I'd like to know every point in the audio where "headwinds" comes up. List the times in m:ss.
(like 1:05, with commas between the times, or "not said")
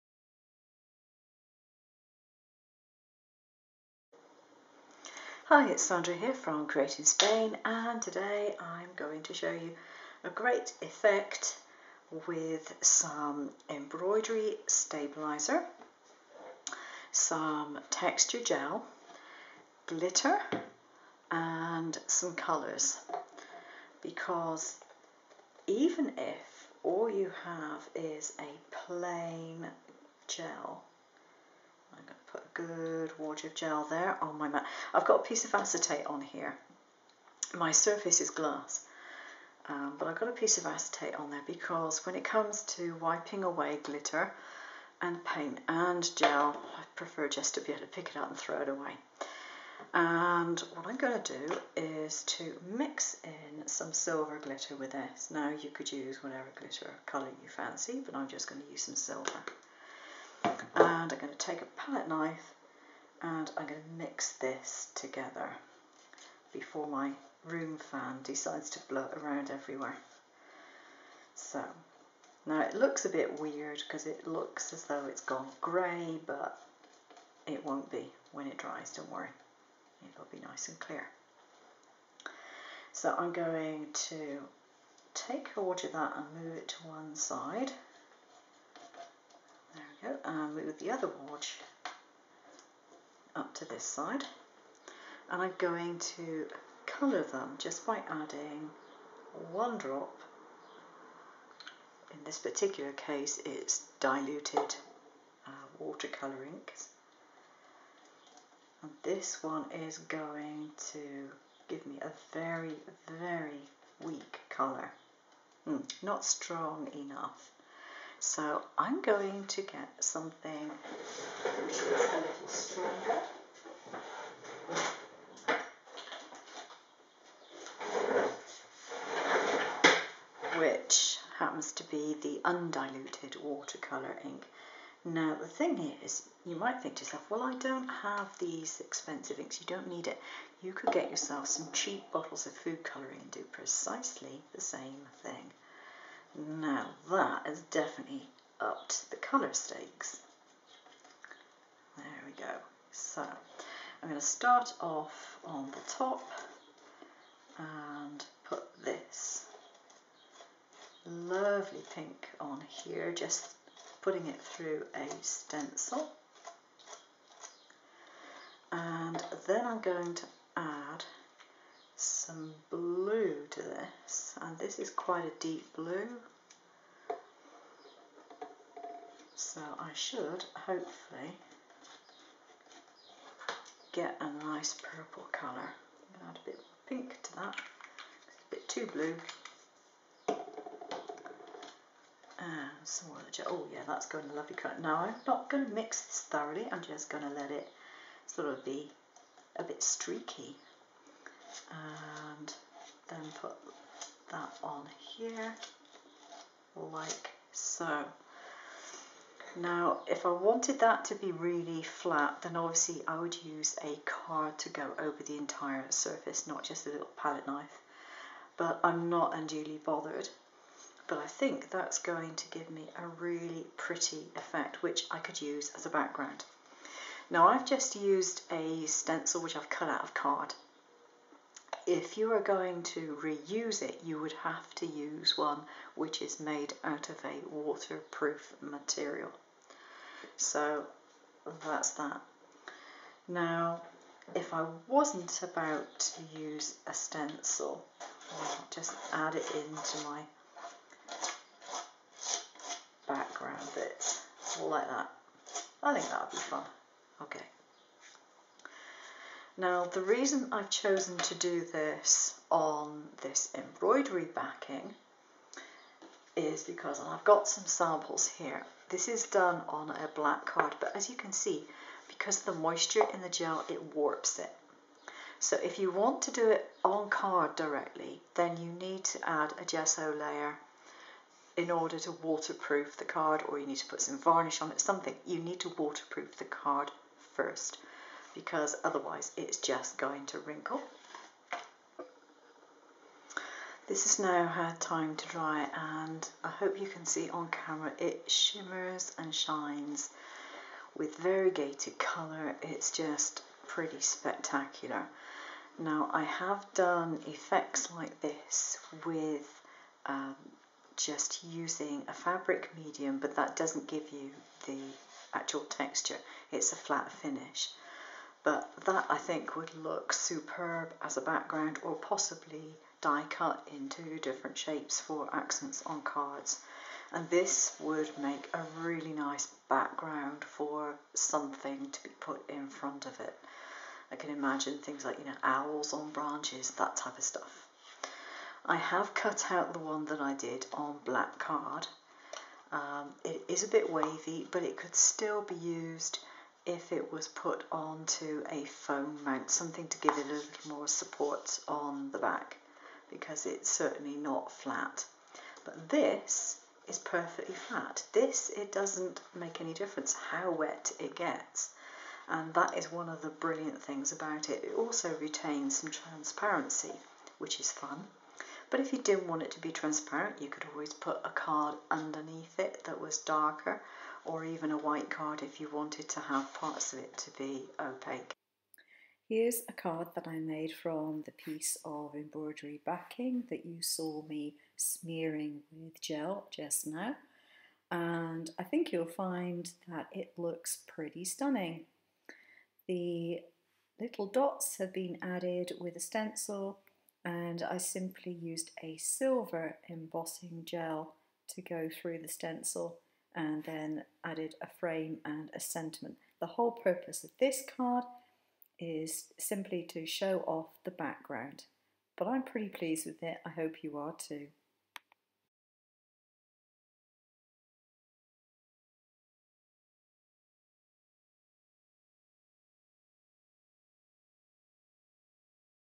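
not said.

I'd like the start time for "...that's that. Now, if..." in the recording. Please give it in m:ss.
4:01.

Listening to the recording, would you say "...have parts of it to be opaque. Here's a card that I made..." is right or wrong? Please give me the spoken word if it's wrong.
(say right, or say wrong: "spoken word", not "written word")
right.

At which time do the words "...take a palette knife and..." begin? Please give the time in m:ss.
1:01.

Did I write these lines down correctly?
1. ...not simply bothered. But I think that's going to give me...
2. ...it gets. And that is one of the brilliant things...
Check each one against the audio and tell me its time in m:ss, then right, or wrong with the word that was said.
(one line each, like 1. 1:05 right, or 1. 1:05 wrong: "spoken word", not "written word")
1. 3:39 wrong: "unduly", not "simply"
2. 6:00 right.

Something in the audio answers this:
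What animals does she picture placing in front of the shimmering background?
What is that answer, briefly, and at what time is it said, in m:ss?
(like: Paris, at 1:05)
owls, at 5:35.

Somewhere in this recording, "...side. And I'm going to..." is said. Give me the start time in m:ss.
1:33.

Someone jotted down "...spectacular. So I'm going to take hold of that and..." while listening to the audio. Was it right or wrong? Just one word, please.
wrong.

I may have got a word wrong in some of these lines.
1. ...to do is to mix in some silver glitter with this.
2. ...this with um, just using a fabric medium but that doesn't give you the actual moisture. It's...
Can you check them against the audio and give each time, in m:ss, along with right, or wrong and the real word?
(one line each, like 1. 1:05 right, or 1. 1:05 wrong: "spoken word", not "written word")
1. 0:51 right
2. 5:08 wrong: "texture", not "moisture".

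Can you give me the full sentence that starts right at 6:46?
The whole purpose of this card is simply to show off the background.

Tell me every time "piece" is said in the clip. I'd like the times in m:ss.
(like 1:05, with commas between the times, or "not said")
0:35, 0:40, 6:21.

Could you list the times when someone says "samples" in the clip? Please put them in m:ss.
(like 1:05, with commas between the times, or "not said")
4:27.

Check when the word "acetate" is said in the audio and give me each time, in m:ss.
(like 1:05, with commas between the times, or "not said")
0:35, 0:40.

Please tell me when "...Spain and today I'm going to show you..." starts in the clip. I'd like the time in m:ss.
0:07.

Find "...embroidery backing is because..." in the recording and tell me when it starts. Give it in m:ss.
4:23.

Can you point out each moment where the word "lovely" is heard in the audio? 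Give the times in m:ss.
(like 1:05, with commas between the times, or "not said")
2:41, 3:14.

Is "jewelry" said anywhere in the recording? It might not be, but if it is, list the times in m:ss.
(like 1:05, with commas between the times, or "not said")
not said.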